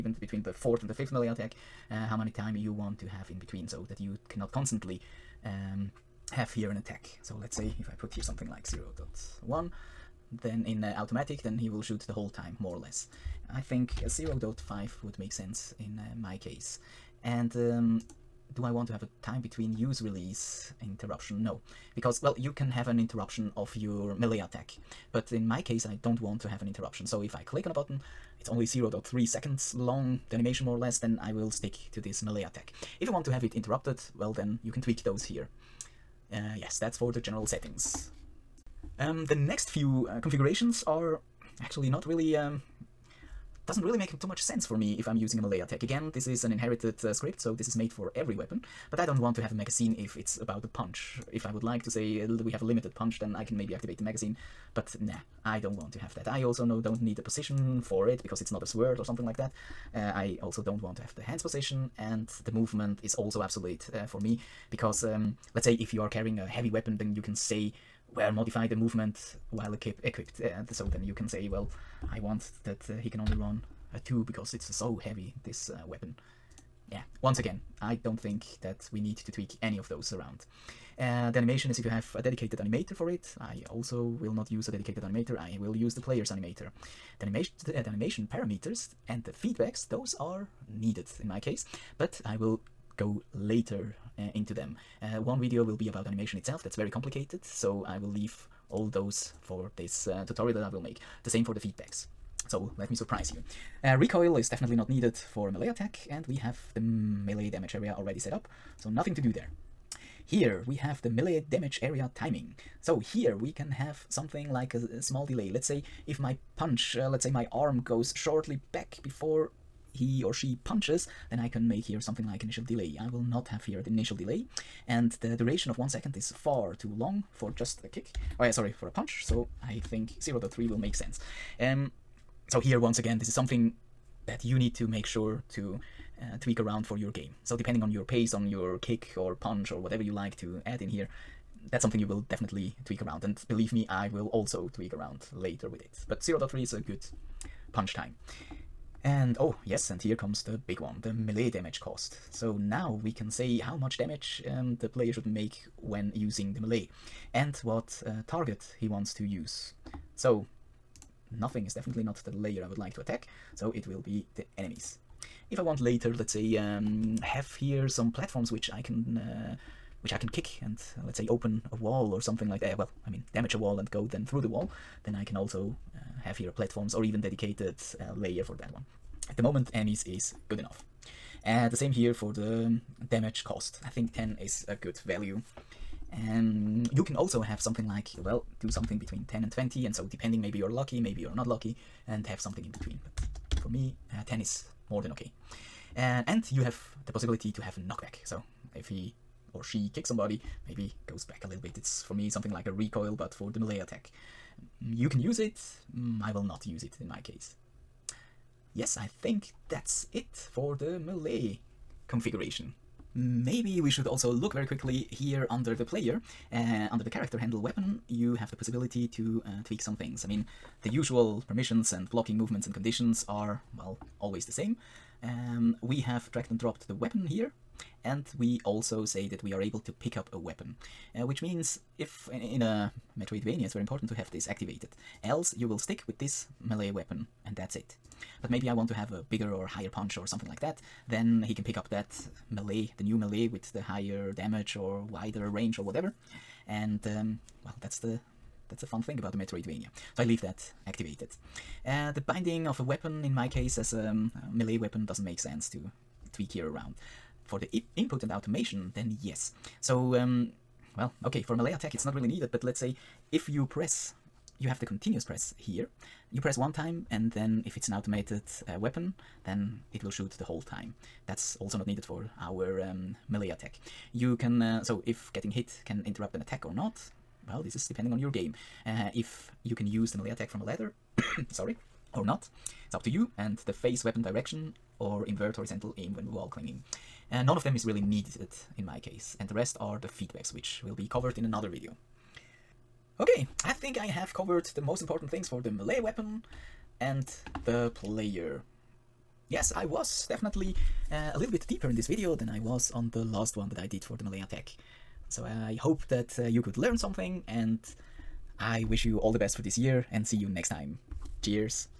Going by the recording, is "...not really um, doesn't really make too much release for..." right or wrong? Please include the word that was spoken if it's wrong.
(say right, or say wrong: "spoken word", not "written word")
wrong: "sense", not "release".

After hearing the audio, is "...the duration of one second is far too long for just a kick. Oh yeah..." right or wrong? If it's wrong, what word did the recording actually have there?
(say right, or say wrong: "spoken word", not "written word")
right.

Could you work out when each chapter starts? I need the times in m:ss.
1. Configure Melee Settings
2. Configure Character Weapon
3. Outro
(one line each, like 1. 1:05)
1. 0:39
2. 3:33
3. 4:52.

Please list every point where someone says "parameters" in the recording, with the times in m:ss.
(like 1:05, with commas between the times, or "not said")
1:28.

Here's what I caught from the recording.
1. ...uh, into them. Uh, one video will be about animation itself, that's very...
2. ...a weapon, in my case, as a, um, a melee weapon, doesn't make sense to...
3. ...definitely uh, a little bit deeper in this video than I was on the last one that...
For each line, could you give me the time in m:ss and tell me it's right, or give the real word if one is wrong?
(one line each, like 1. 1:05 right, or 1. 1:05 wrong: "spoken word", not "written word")
1. 1:34 right
2. 4:12 right
3. 5:00 right.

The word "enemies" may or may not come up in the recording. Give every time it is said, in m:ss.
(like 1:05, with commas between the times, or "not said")
2:44, 2:59.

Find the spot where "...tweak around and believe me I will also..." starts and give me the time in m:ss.
2:22.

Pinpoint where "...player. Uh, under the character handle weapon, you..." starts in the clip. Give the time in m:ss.
3:35.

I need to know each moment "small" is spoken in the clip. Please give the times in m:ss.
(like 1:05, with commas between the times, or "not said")
1:55.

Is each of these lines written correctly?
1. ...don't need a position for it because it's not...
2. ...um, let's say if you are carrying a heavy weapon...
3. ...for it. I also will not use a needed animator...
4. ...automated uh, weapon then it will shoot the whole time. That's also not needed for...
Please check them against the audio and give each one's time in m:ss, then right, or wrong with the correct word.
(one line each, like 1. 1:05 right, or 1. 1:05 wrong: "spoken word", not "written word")
1. 0:56 right
2. 1:05 right
3. 1:22 wrong: "dedicated", not "needed"
4. 4:27 right.